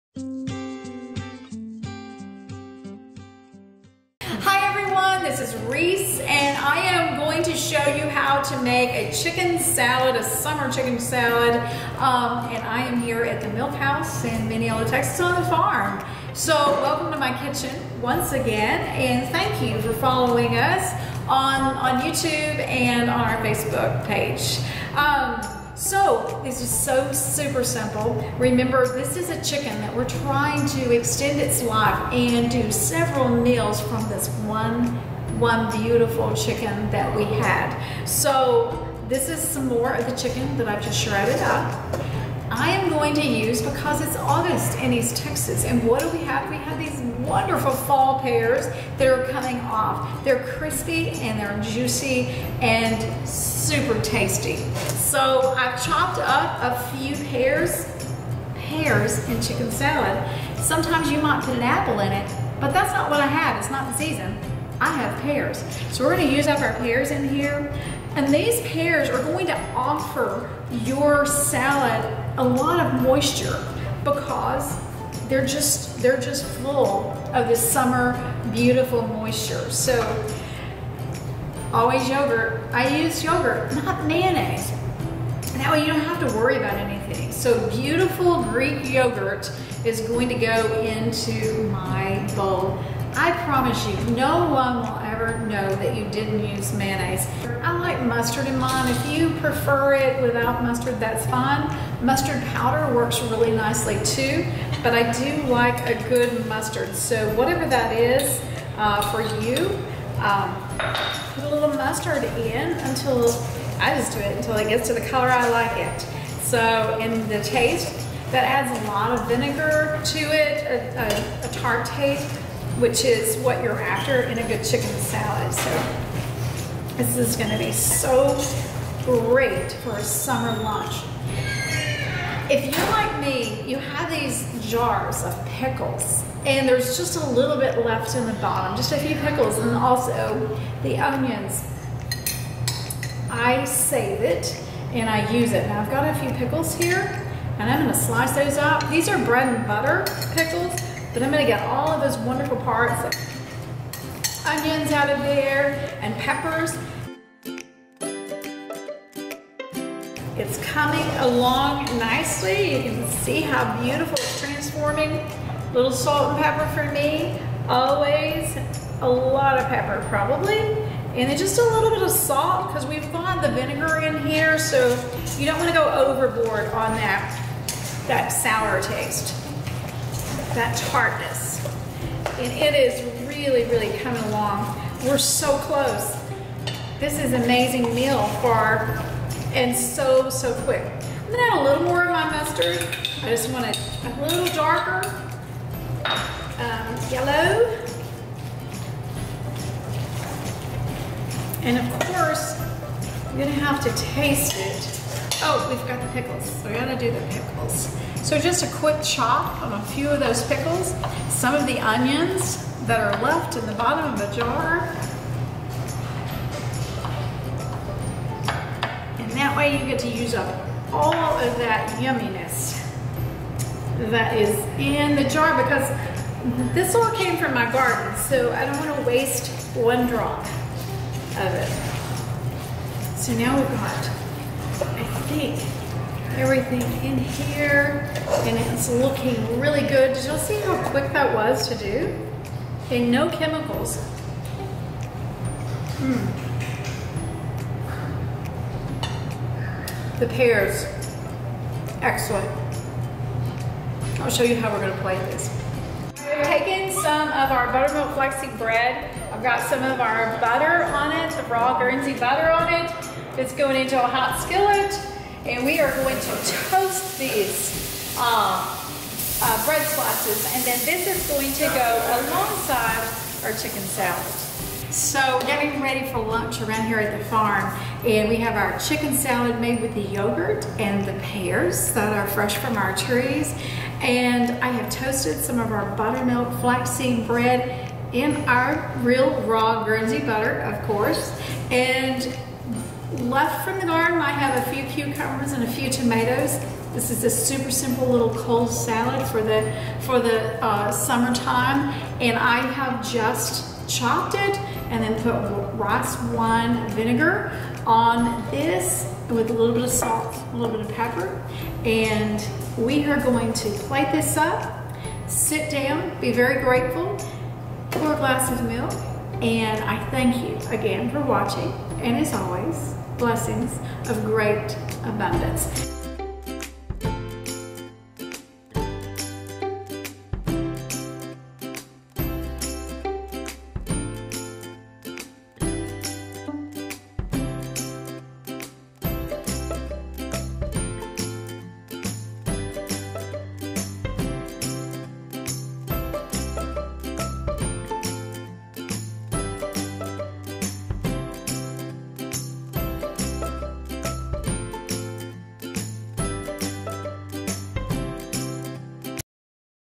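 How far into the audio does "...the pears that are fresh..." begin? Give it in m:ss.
4:41.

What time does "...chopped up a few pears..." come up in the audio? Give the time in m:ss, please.
0:55.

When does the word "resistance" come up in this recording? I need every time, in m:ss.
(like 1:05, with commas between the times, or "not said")
not said.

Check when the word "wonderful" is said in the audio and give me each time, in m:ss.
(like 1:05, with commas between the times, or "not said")
0:47, 2:32.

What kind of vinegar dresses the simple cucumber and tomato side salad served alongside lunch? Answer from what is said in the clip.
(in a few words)
rice wine vinegar.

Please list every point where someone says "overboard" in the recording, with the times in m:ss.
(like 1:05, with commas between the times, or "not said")
2:55.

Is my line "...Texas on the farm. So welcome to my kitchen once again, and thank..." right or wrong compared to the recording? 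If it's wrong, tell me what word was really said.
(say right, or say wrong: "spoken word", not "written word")
right.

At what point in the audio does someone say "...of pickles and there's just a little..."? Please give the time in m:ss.
2:15.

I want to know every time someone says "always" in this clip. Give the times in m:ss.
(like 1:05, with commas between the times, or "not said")
1:21, 2:47, 5:22.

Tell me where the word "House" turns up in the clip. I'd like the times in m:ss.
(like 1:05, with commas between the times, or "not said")
0:13.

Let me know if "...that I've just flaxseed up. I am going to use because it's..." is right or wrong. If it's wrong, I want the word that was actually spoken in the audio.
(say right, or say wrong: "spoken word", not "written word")
wrong: "shredded", not "flaxseed".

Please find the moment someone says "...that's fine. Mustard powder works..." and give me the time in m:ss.
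1:40.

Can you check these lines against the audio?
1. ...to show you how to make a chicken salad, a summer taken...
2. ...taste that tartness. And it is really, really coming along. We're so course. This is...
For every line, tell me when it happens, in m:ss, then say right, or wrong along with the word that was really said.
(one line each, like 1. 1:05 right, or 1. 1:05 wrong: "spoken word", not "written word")
1. 0:07 wrong: "chicken", not "taken"
2. 2:58 wrong: "close", not "course".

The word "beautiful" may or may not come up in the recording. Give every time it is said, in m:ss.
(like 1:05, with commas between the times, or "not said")
0:35, 1:18, 1:27, 2:43.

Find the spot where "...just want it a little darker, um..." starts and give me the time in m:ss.
3:13.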